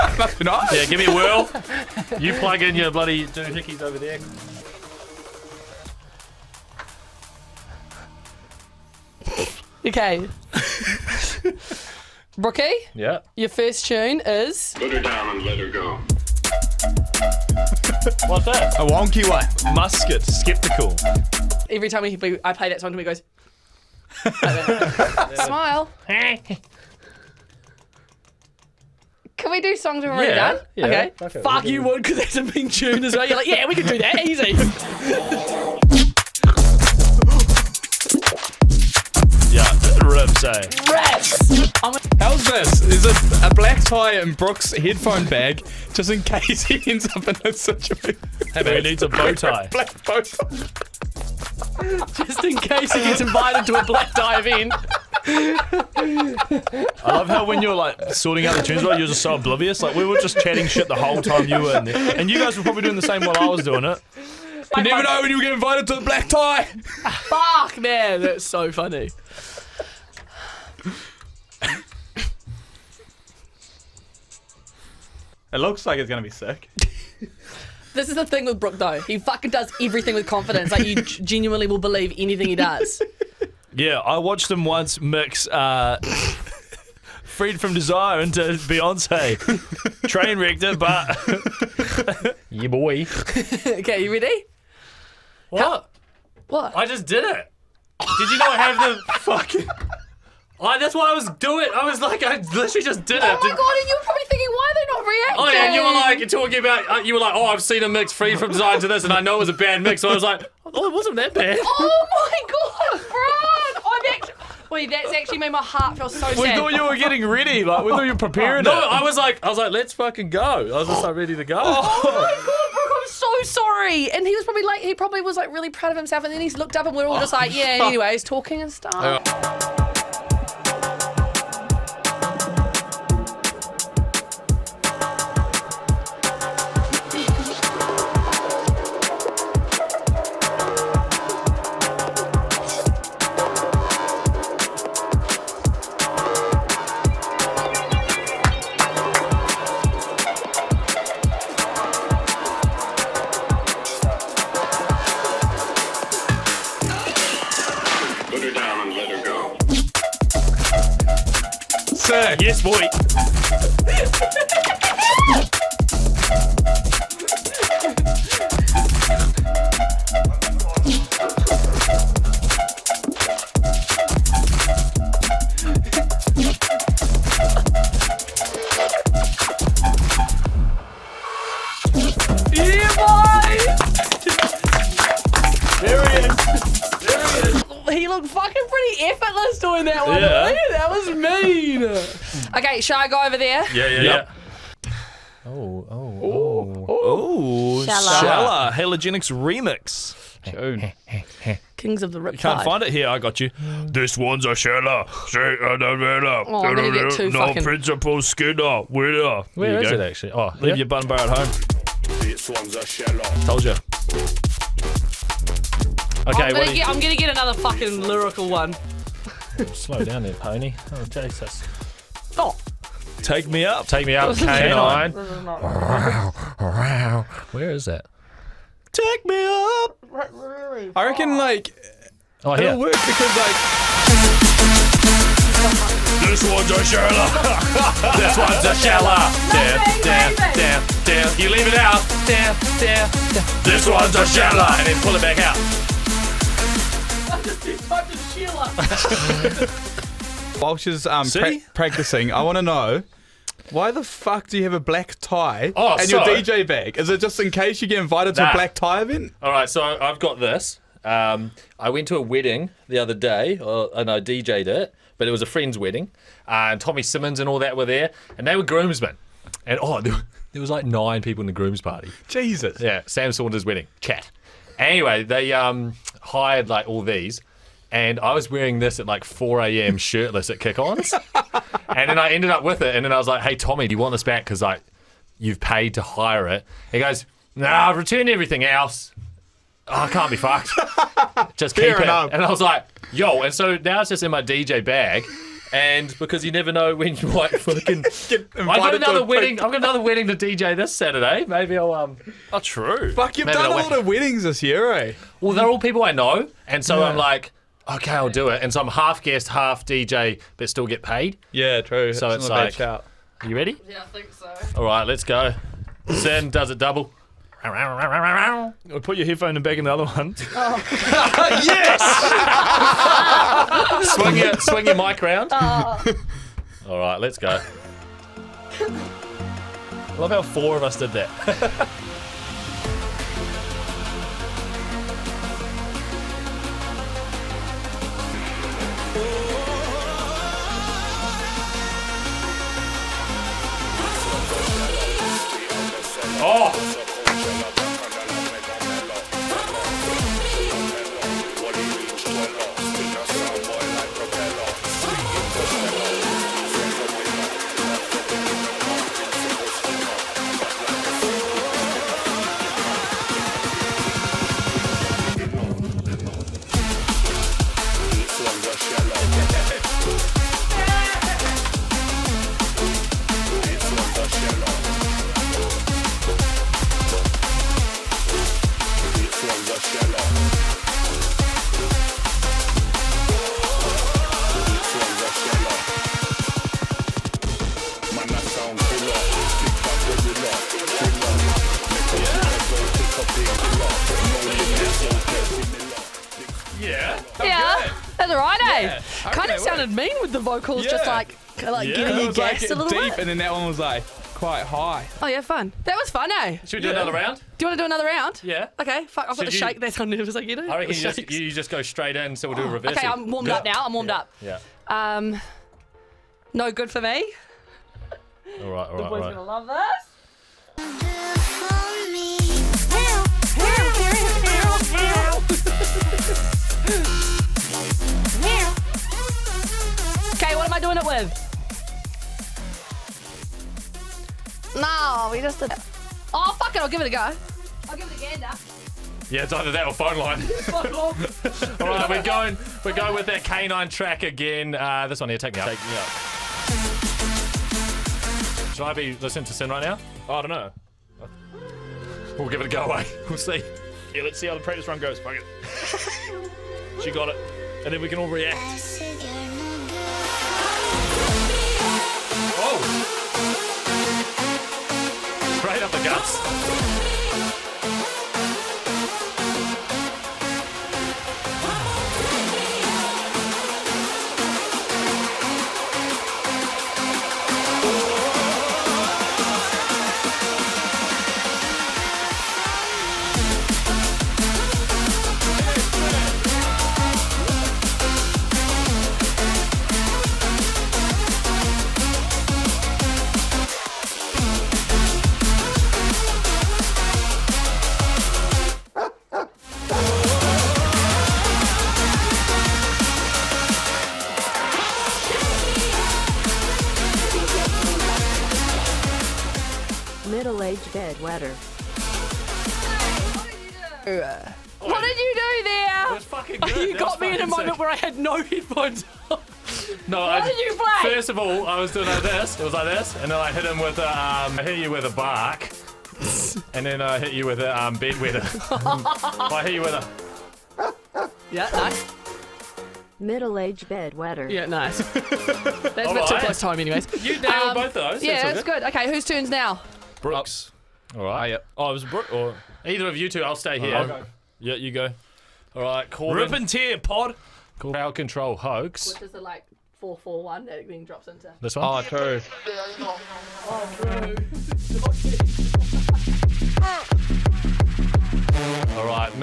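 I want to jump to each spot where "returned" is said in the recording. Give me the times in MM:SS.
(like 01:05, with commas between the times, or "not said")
04:47.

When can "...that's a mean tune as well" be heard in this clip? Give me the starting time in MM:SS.
00:32.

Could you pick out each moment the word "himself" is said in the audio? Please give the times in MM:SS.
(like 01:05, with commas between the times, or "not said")
02:05.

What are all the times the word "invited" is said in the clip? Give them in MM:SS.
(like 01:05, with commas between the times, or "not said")
00:53, 01:05, 04:17.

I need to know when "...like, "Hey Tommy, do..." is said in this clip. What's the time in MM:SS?
04:43.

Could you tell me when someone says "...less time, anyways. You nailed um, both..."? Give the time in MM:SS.
08:56.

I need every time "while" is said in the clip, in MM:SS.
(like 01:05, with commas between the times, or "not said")
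01:03, 04:10.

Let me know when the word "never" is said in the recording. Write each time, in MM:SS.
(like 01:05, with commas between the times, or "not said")
01:04, 04:56.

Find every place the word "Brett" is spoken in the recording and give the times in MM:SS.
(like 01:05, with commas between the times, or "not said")
not said.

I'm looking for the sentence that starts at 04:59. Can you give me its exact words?
I've got another wedding to DJ this Saturday.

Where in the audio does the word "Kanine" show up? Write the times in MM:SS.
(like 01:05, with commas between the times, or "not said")
03:44, 07:23.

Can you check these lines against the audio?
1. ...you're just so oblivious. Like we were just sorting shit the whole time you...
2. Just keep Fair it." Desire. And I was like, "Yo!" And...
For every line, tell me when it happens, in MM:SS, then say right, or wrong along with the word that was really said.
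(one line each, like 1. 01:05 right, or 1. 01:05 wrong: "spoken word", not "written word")
1. 00:58 wrong: "chatting", not "sorting"
2. 04:51 wrong: "Enough", not "Desire".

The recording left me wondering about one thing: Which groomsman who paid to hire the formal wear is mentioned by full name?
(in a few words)
Tommy Simmons.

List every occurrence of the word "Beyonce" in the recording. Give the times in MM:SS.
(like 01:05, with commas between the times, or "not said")
01:28.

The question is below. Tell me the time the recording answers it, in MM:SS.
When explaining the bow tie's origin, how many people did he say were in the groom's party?
04:30.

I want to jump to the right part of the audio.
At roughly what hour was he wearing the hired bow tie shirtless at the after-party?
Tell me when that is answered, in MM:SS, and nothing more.
04:39.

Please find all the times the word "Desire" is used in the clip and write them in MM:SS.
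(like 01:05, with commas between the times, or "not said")
01:27, 01:48.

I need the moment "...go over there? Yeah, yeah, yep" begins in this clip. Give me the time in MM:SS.
03:13.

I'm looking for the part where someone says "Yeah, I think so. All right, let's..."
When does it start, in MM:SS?
05:13.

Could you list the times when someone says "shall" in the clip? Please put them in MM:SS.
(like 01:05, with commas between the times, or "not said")
03:12.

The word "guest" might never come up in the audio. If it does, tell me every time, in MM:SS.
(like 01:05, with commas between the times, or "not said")
05:09.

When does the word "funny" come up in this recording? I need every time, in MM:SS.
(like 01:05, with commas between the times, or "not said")
01:08.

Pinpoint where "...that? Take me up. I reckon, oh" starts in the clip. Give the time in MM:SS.
03:47.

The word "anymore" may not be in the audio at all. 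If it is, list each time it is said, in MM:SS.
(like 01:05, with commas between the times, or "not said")
not said.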